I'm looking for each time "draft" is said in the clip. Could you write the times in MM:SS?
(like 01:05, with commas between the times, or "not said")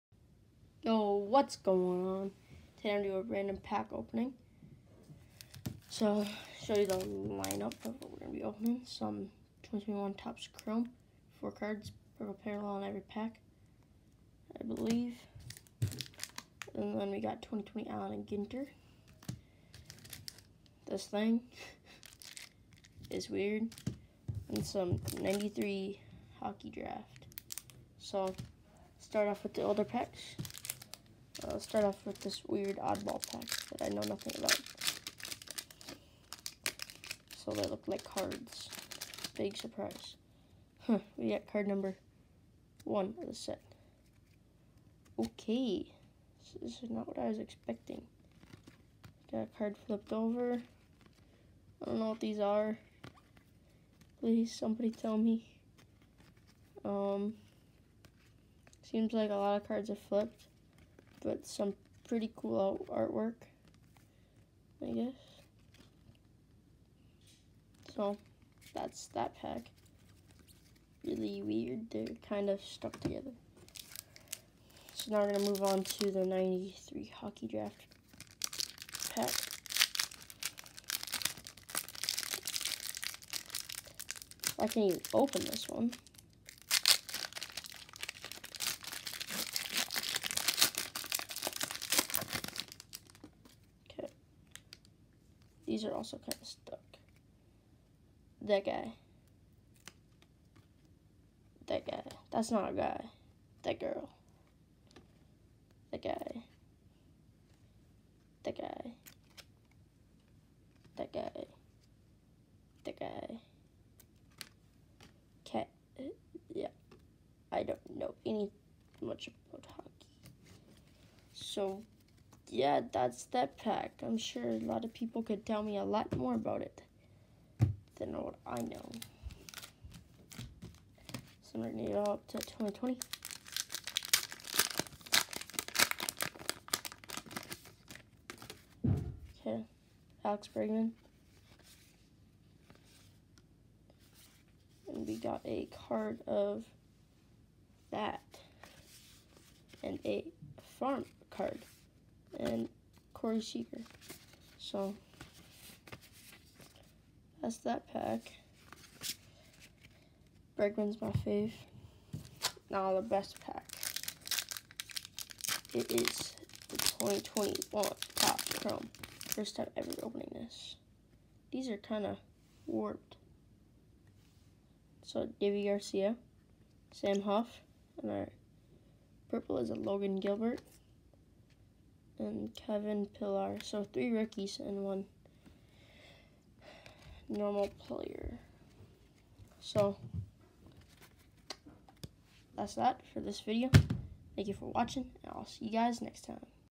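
00:26, 01:17.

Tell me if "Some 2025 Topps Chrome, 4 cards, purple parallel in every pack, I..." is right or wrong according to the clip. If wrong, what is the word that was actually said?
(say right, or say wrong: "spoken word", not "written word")
wrong: "2021", not "2025".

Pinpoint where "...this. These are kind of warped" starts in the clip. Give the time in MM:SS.
02:50.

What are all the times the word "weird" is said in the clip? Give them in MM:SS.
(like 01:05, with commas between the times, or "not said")
00:23, 00:32, 01:11.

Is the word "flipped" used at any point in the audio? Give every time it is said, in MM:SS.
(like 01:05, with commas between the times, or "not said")
00:49, 00:59.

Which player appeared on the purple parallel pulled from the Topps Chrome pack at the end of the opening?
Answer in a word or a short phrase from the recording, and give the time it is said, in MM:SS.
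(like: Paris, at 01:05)
Logan Gilbert, at 02:59.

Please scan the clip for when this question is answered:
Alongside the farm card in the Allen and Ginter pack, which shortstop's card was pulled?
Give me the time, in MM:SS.
02:33.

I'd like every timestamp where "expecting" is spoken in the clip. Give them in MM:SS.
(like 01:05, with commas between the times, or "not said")
00:47.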